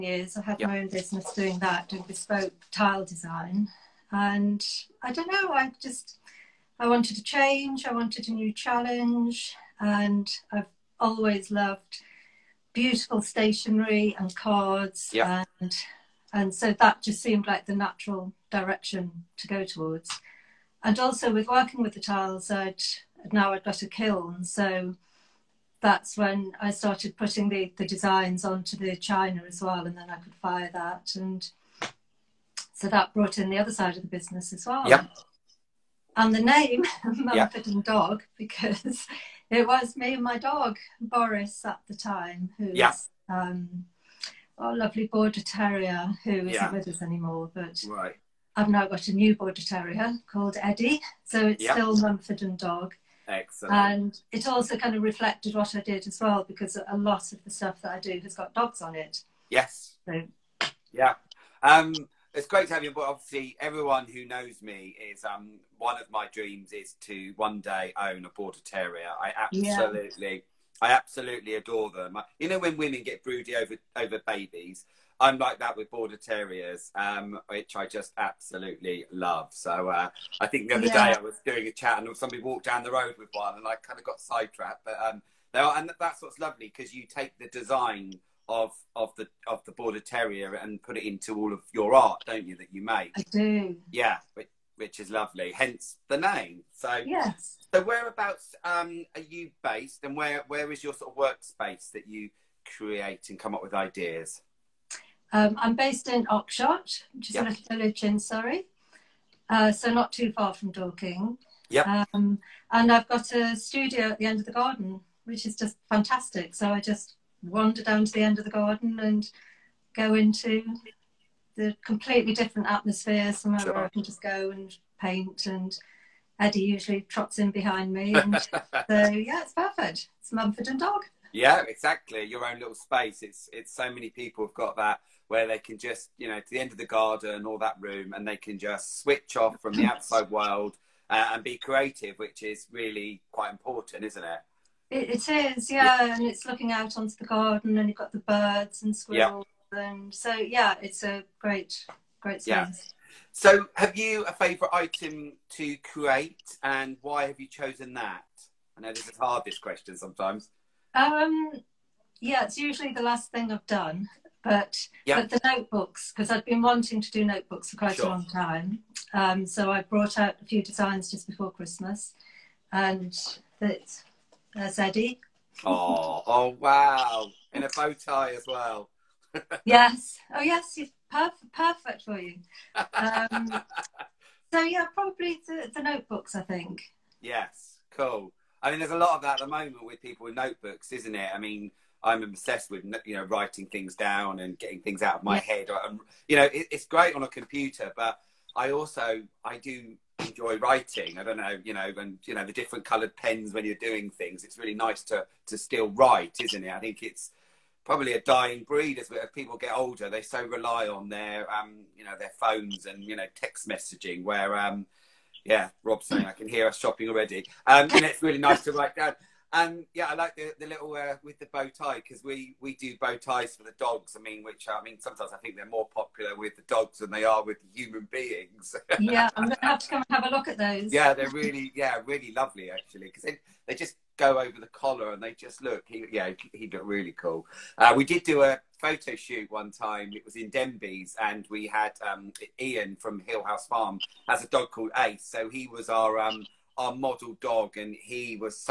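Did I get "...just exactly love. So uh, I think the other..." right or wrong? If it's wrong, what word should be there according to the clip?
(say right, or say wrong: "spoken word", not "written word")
wrong: "absolutely", not "exactly".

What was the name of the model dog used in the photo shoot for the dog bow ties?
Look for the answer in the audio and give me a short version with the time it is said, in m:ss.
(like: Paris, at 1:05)
Ace, at 4:04.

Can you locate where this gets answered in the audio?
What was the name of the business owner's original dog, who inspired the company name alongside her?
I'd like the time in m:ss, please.
0:40.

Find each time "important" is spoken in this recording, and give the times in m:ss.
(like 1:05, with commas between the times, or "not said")
2:23.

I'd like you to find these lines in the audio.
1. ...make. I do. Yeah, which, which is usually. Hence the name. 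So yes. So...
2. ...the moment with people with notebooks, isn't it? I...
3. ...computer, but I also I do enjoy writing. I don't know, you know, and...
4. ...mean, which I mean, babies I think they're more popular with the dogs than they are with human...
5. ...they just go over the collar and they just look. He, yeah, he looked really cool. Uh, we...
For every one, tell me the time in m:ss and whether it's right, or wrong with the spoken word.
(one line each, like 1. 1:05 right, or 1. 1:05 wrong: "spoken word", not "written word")
1. 1:32 wrong: "lovely", not "usually"
2. 3:09 right
3. 3:17 right
4. 3:44 wrong: "sometimes", not "babies"
5. 3:53 right.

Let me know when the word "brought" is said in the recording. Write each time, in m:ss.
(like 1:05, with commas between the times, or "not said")
0:33, 2:49.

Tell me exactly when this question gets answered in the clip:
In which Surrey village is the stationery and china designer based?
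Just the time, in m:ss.
1:46.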